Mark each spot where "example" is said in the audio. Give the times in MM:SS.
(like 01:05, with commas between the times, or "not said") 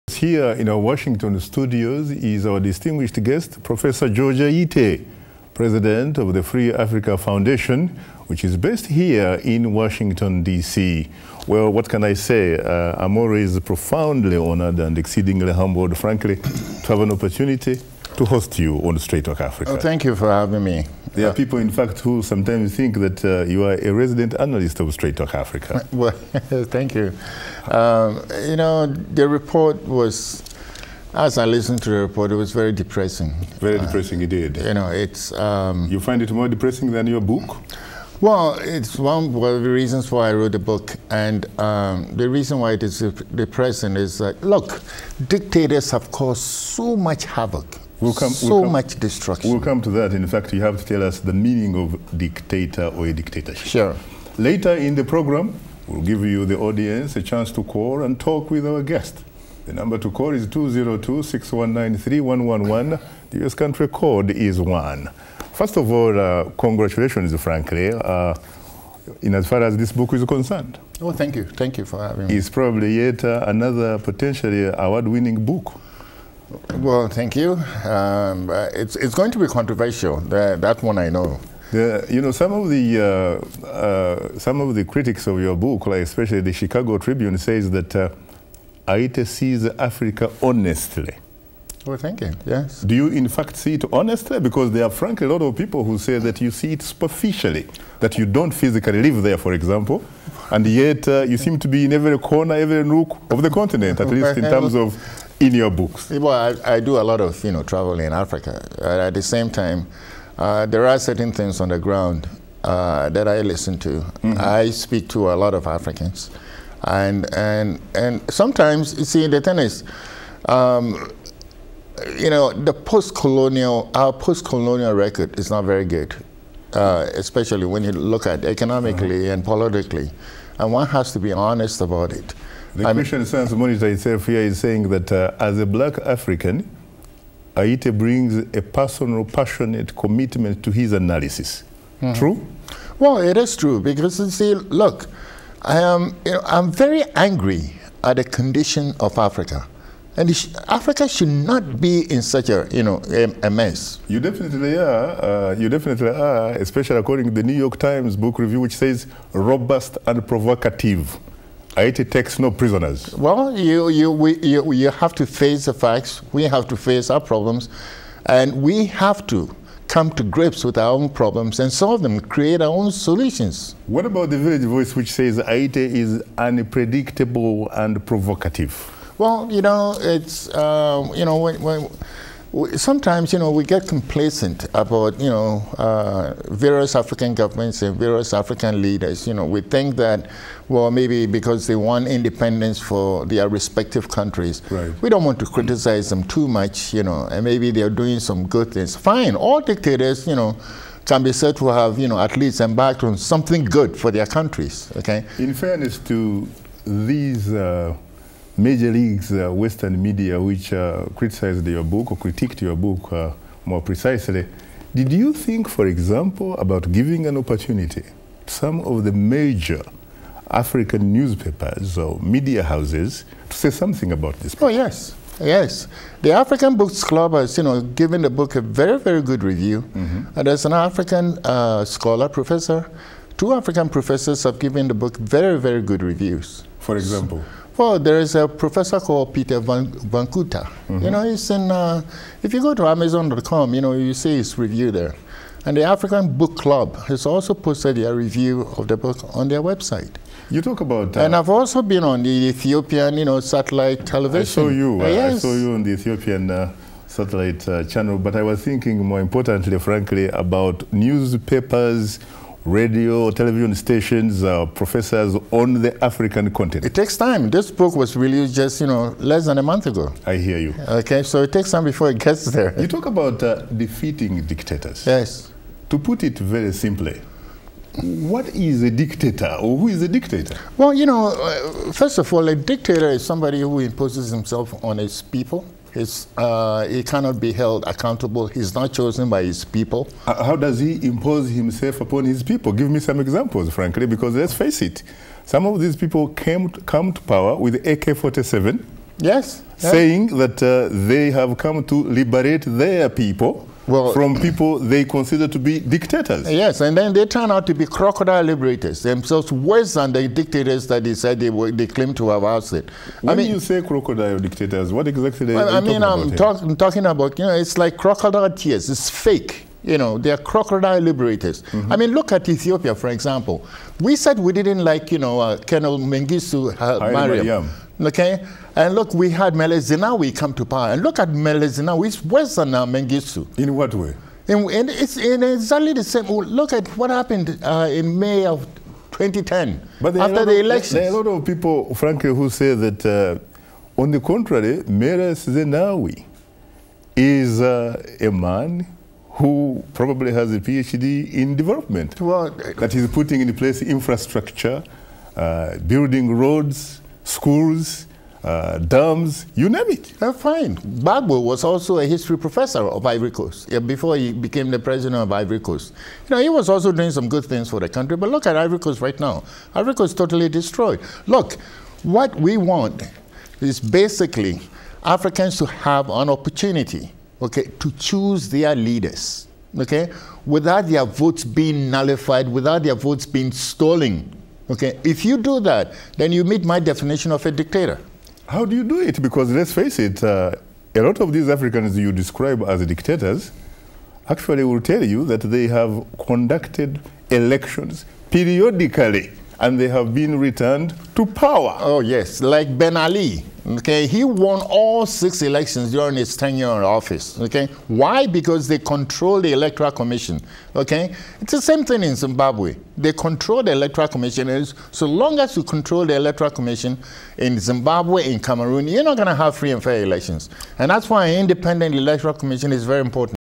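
01:39, 03:35, 03:56, 04:53, 05:23.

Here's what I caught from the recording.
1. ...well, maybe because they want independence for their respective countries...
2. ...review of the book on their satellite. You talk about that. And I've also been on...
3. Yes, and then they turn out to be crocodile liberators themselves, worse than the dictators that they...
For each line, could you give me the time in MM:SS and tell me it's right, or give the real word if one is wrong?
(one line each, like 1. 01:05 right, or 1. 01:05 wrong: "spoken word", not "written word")
1. 03:10 right
2. 04:08 wrong: "website", not "satellite"
3. 05:06 right.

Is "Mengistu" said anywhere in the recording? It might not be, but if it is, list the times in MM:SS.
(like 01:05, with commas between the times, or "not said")
05:25, 05:32.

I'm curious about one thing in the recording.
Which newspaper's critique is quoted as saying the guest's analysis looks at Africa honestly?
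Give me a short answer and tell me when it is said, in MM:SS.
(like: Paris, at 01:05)
Chicago Tribune, at 01:26.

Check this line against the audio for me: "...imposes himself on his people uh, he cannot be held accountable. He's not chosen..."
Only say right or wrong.
right.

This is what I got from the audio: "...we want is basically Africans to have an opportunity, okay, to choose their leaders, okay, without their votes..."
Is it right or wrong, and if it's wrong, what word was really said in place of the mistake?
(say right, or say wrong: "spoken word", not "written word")
right.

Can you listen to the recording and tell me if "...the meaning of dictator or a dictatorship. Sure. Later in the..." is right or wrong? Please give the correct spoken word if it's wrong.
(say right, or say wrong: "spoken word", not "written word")
right.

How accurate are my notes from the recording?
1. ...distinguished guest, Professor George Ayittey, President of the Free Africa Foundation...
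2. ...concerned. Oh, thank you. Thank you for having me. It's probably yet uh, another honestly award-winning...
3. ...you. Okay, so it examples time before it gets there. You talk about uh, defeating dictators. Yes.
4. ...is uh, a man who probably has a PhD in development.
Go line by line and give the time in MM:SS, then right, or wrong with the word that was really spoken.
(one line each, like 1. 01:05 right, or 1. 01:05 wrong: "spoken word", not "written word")
1. 00:02 right
2. 01:10 wrong: "potentially", not "honestly"
3. 04:30 wrong: "takes", not "examples"
4. 05:47 right.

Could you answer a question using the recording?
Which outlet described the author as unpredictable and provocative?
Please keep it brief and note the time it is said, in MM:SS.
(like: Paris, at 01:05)
Village Voice, at 02:54.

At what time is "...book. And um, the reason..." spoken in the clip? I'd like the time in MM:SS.
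00:40.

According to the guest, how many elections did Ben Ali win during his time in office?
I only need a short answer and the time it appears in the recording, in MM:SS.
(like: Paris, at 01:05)
6, at 06:45.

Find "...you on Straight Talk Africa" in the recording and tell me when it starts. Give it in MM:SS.
00:18.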